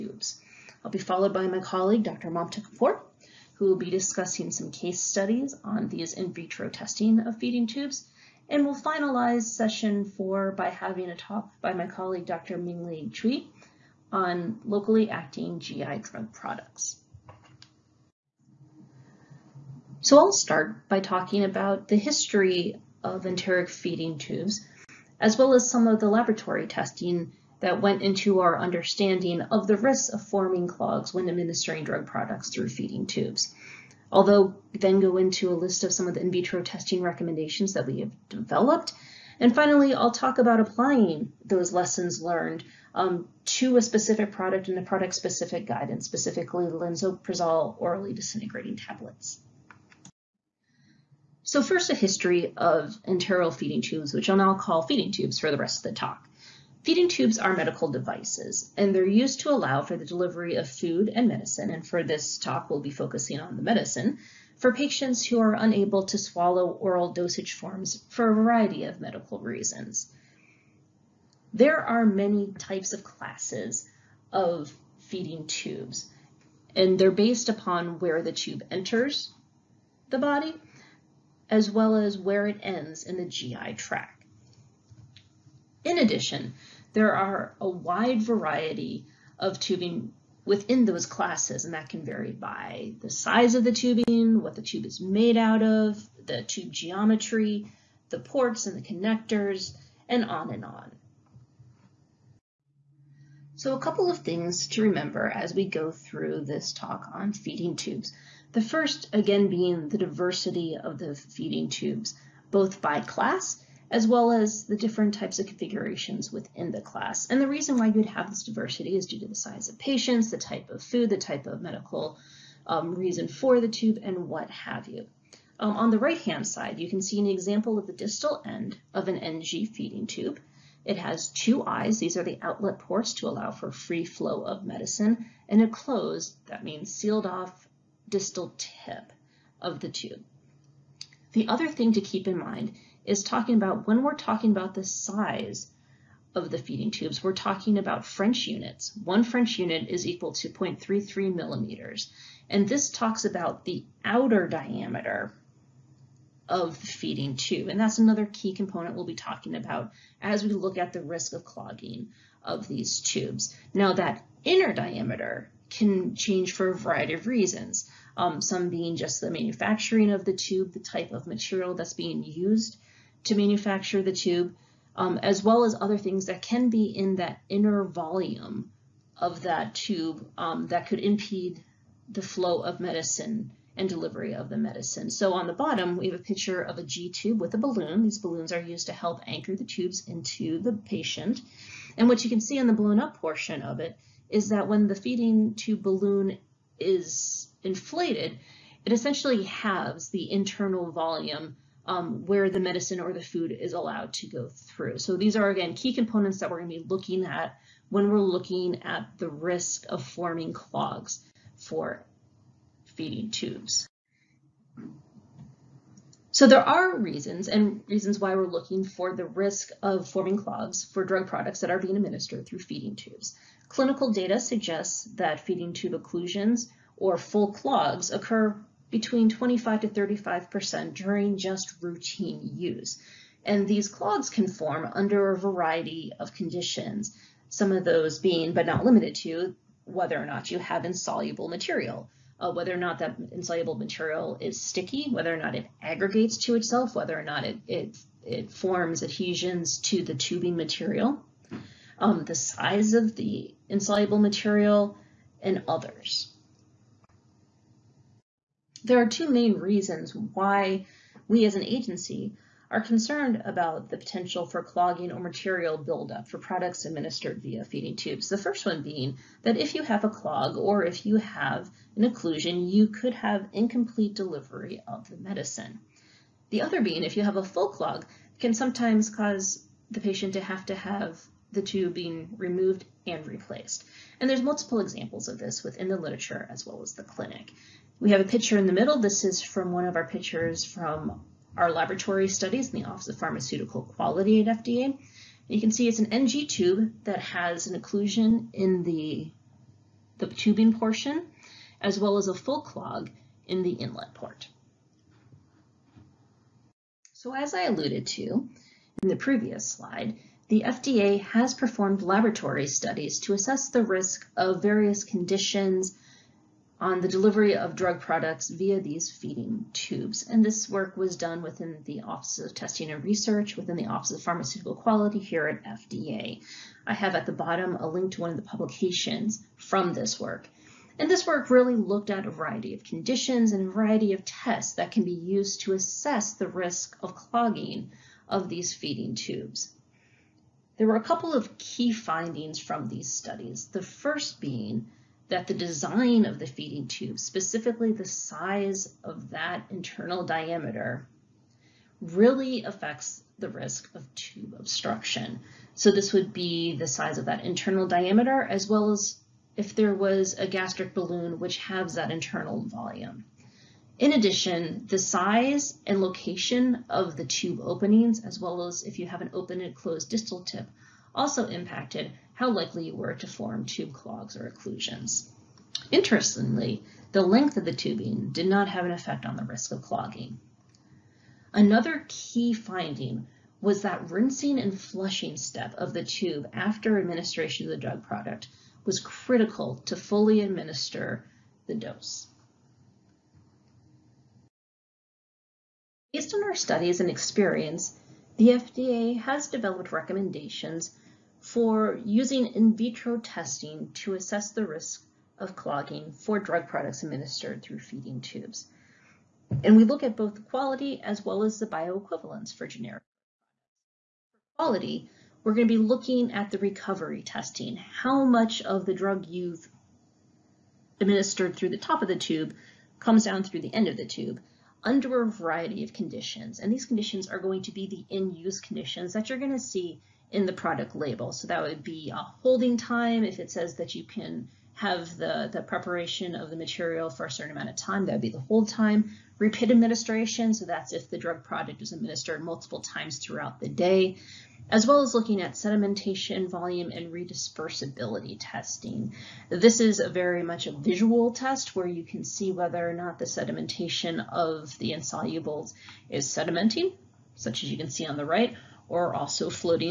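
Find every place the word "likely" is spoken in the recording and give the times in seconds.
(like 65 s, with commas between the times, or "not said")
372 s.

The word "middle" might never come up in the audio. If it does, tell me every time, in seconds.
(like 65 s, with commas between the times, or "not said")
288 s.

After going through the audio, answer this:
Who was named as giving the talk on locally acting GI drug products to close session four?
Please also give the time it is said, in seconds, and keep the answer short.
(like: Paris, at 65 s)
Dr. Ming Li Chui, at 12 s.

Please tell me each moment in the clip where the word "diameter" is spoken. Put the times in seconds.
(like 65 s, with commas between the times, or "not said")
154 s, 164 s, 350 s, 357 s.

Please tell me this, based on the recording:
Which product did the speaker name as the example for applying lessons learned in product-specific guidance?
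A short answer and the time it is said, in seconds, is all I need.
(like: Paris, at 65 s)
Lansoprazole orally disintegrating tablets, at 46 s.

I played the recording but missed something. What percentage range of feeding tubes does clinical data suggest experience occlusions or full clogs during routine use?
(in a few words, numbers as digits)
25 to 35%.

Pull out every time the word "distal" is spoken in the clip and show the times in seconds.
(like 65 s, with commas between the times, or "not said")
127 s, 138 s, 370 s.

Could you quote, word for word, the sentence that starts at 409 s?
And we look at both the quality as well as the bioequivalence for generic products.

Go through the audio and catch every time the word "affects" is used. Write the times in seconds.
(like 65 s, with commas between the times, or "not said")
352 s.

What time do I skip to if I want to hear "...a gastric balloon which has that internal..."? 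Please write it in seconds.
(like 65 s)
360 s.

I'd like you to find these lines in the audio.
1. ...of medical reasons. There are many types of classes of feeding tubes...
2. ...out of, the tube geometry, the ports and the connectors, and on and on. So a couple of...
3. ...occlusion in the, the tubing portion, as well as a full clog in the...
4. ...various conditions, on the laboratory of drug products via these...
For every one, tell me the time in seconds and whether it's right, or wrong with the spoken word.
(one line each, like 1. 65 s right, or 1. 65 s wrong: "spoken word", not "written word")
1. 68 s right
2. 95 s right
3. 297 s right
4. 314 s wrong: "delivery", not "laboratory".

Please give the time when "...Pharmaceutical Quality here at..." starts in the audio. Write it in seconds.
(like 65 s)
324 s.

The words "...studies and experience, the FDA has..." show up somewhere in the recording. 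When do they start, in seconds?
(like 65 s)
396 s.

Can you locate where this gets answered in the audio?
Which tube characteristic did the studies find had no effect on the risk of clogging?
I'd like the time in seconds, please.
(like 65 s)
377 s.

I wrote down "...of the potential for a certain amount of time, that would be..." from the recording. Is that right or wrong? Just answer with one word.
wrong.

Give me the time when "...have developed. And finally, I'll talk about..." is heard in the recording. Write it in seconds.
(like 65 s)
38 s.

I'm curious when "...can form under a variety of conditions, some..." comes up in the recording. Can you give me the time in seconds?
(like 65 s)
234 s.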